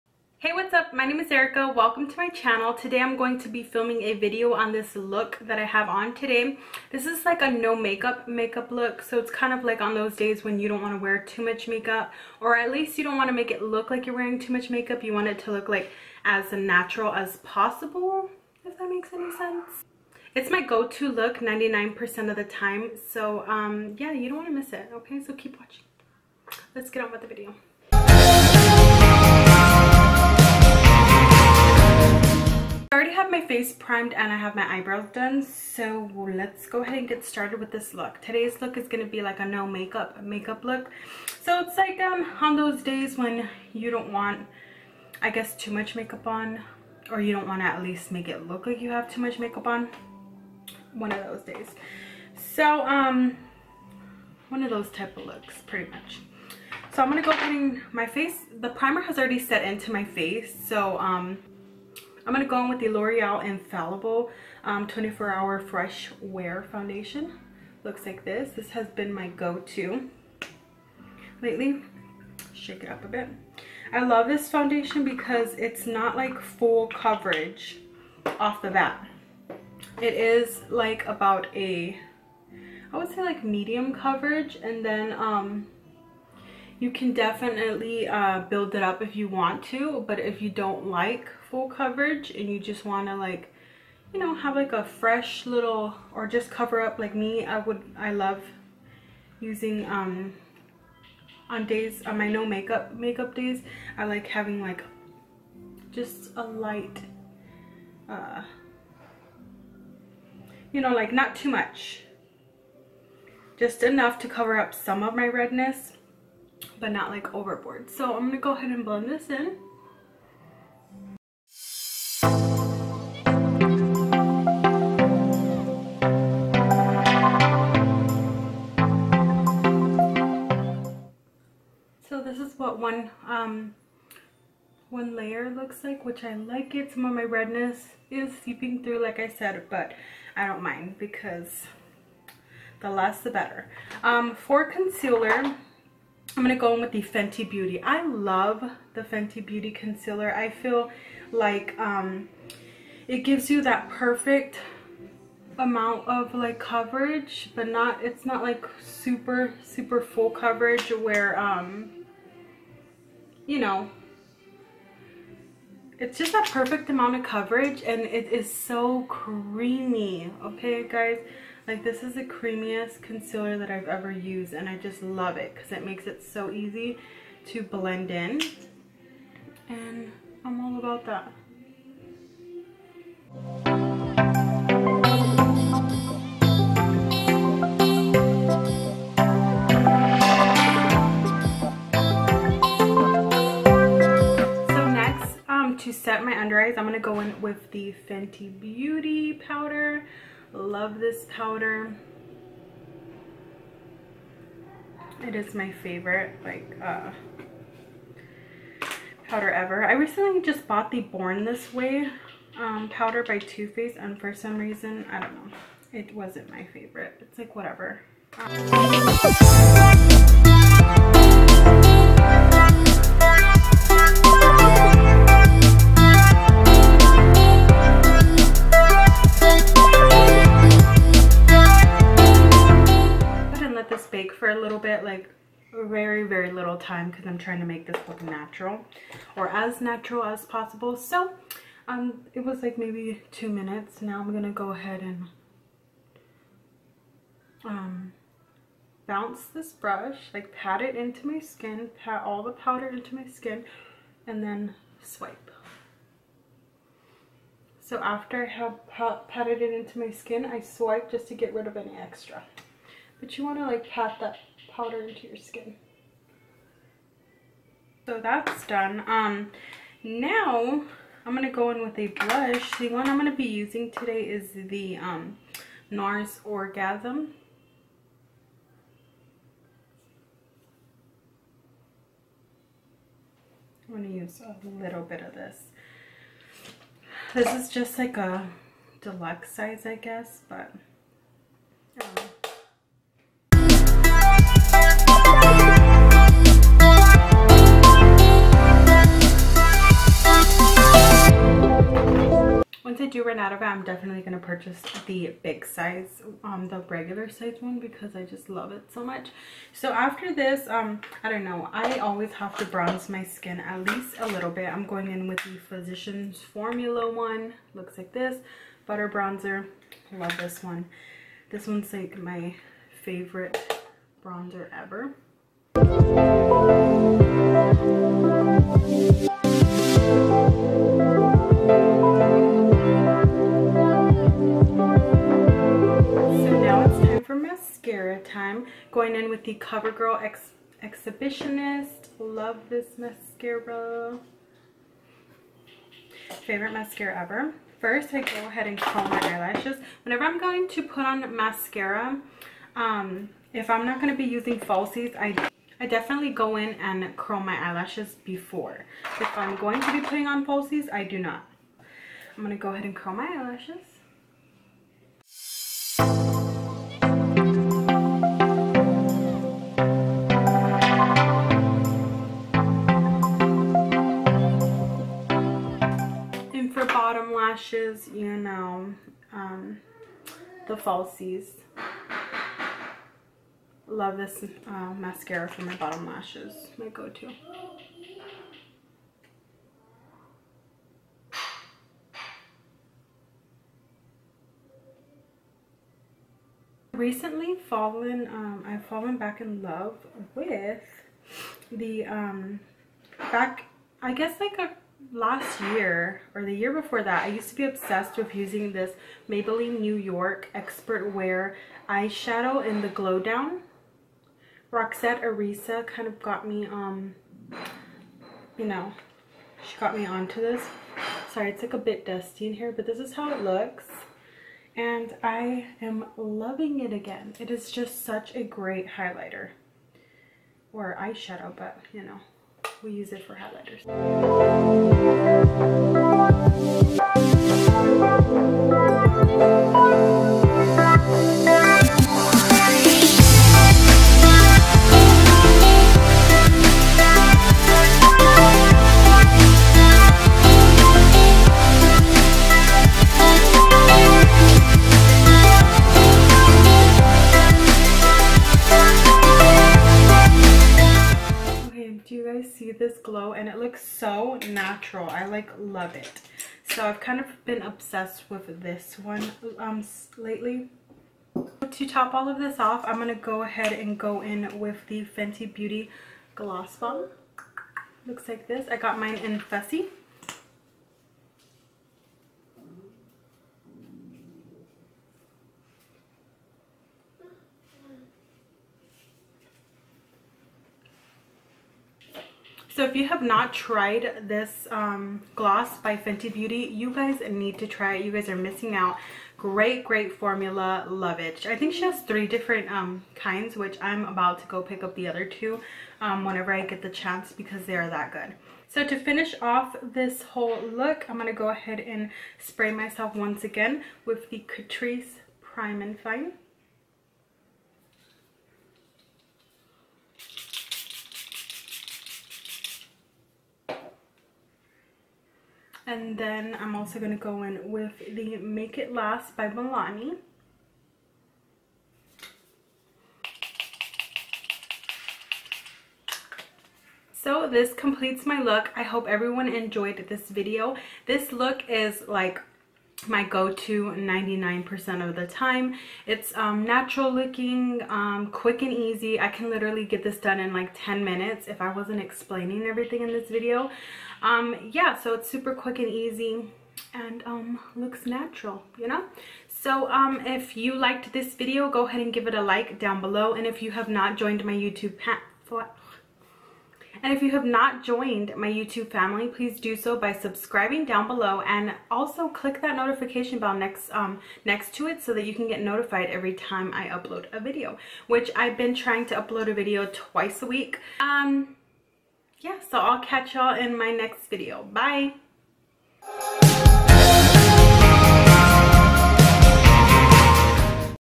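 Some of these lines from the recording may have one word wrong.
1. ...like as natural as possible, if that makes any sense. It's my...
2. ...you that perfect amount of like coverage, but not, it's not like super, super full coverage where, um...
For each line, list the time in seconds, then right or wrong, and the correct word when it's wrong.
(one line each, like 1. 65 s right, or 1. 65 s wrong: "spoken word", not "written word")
1. 15 s right
2. 153 s right.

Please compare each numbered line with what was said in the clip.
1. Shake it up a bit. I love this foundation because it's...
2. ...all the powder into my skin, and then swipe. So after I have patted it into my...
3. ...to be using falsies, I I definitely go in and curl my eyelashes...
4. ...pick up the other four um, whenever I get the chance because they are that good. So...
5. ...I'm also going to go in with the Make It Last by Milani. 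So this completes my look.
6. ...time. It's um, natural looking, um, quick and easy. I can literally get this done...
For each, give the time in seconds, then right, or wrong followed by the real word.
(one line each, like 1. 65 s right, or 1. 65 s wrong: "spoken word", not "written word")
1. 72 s right
2. 252 s right
3. 354 s right
4. 504 s wrong: "two", not "four"
5. 526 s right
6. 545 s right.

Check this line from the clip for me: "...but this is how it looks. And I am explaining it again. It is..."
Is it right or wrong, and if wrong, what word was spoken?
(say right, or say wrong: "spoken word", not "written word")
wrong: "loving", not "explaining".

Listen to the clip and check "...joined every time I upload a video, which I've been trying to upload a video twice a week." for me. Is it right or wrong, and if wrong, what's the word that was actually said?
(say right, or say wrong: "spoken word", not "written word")
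wrong: "notified", not "joined".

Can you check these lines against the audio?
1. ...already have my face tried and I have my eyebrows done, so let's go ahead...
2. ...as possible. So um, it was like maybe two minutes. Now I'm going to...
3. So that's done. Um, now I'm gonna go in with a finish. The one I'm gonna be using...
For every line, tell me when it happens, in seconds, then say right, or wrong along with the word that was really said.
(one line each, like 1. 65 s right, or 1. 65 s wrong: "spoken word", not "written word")
1. 32 s wrong: "primed", not "tried"
2. 240 s right
3. 268 s wrong: "blush", not "finish".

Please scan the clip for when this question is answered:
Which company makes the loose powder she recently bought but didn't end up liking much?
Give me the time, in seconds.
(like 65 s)
213 s.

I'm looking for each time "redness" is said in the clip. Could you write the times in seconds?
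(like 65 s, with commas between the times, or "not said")
115 s, 137 s.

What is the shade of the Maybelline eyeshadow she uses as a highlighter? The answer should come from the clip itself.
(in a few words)
Glow Down.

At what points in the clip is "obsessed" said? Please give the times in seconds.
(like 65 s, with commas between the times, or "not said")
407 s, 467 s.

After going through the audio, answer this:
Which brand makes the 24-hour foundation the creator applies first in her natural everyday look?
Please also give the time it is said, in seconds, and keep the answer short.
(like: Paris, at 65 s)
L'Oreal, at 62 s.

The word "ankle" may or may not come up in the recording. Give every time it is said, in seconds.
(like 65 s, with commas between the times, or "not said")
not said.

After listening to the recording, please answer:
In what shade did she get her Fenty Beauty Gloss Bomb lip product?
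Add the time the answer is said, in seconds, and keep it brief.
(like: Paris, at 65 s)
Fussy, at 479 s.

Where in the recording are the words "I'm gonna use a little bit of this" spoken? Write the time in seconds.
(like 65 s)
283 s.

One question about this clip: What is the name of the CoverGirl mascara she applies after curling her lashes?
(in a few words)
Exhibitionist.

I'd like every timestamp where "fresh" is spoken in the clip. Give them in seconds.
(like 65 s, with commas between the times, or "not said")
65 s, 94 s.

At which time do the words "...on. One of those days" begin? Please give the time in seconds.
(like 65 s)
49 s.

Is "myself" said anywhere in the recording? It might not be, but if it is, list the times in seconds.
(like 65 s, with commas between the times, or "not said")
512 s.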